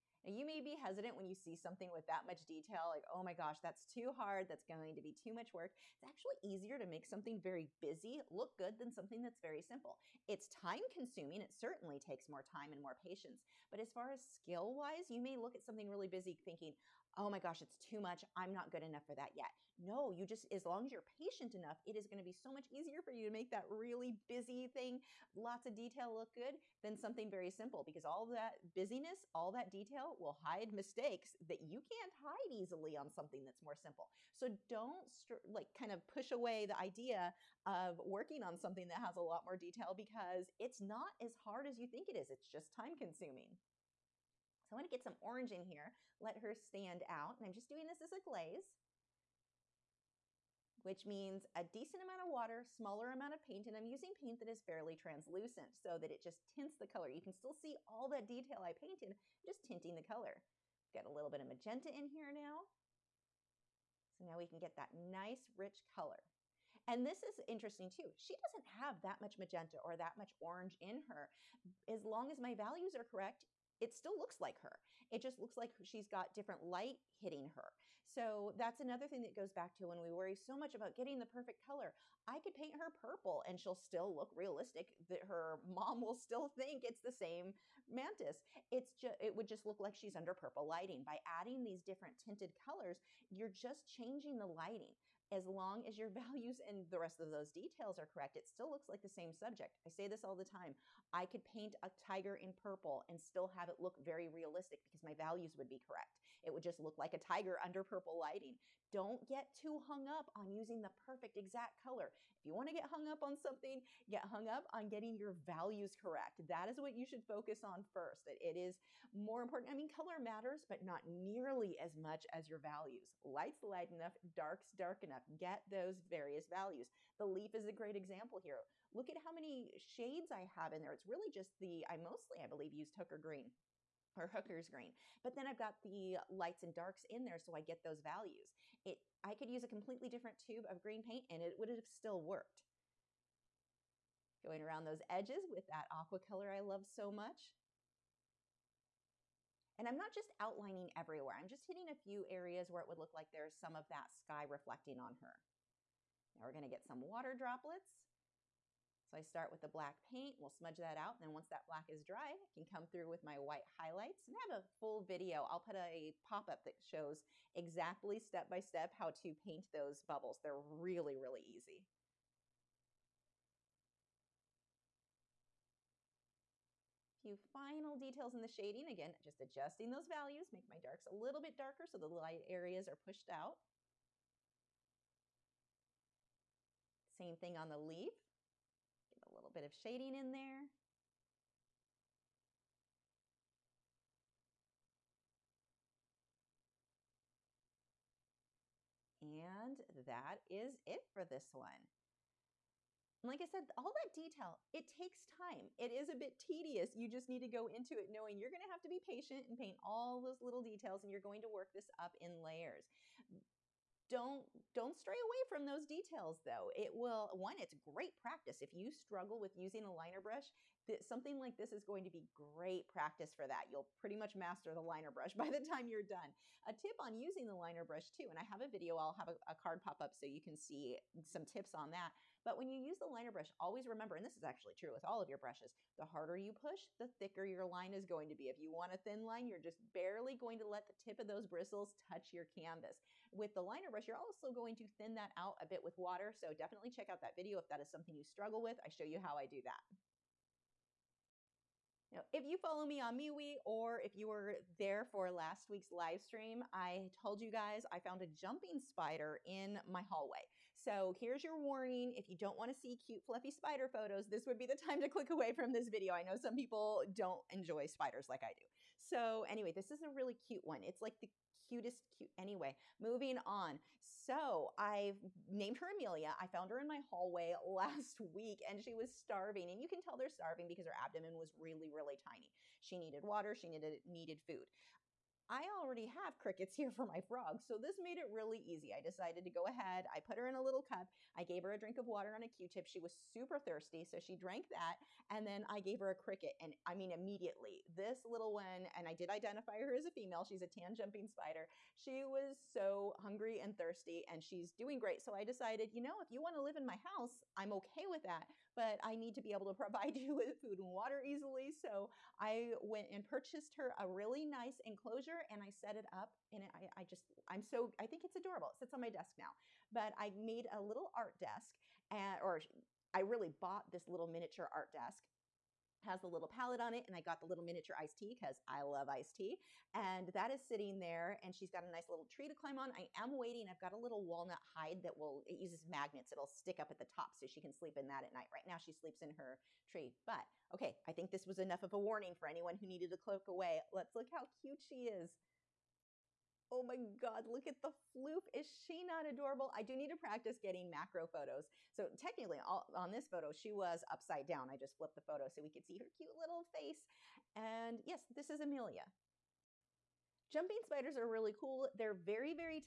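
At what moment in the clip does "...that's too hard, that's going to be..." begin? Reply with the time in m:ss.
0:03.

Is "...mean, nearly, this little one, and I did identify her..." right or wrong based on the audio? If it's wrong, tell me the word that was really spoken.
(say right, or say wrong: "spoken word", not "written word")
wrong: "immediately", not "nearly".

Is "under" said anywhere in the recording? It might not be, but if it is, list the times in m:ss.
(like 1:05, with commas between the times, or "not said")
1:30, 1:47.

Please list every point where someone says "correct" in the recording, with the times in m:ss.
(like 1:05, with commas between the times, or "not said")
1:13, 1:38, 1:45, 1:55.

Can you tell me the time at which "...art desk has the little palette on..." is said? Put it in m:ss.
5:24.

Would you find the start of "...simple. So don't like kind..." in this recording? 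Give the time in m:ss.
0:33.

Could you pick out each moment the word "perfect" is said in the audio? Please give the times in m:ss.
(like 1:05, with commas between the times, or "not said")
1:21, 1:50.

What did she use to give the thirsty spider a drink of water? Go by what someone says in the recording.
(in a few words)
Q-tip.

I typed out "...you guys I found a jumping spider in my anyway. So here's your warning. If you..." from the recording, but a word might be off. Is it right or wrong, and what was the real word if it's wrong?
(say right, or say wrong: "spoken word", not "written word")
wrong: "hallway", not "anyway".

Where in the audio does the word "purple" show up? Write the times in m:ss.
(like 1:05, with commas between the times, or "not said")
1:22, 1:30, 1:42, 1:47.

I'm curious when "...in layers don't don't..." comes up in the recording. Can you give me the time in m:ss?
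3:32.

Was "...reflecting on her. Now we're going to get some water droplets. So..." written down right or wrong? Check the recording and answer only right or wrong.
right.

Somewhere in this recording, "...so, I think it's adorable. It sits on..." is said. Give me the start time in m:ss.
5:17.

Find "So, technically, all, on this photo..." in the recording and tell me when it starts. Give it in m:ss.
5:51.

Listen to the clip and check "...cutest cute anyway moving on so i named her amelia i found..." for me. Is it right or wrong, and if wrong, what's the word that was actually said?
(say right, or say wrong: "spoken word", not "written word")
right.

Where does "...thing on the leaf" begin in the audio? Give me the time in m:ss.
3:07.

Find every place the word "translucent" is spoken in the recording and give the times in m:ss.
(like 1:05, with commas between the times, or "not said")
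0:54.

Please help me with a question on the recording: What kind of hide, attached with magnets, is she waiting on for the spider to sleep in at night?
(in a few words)
walnut hide.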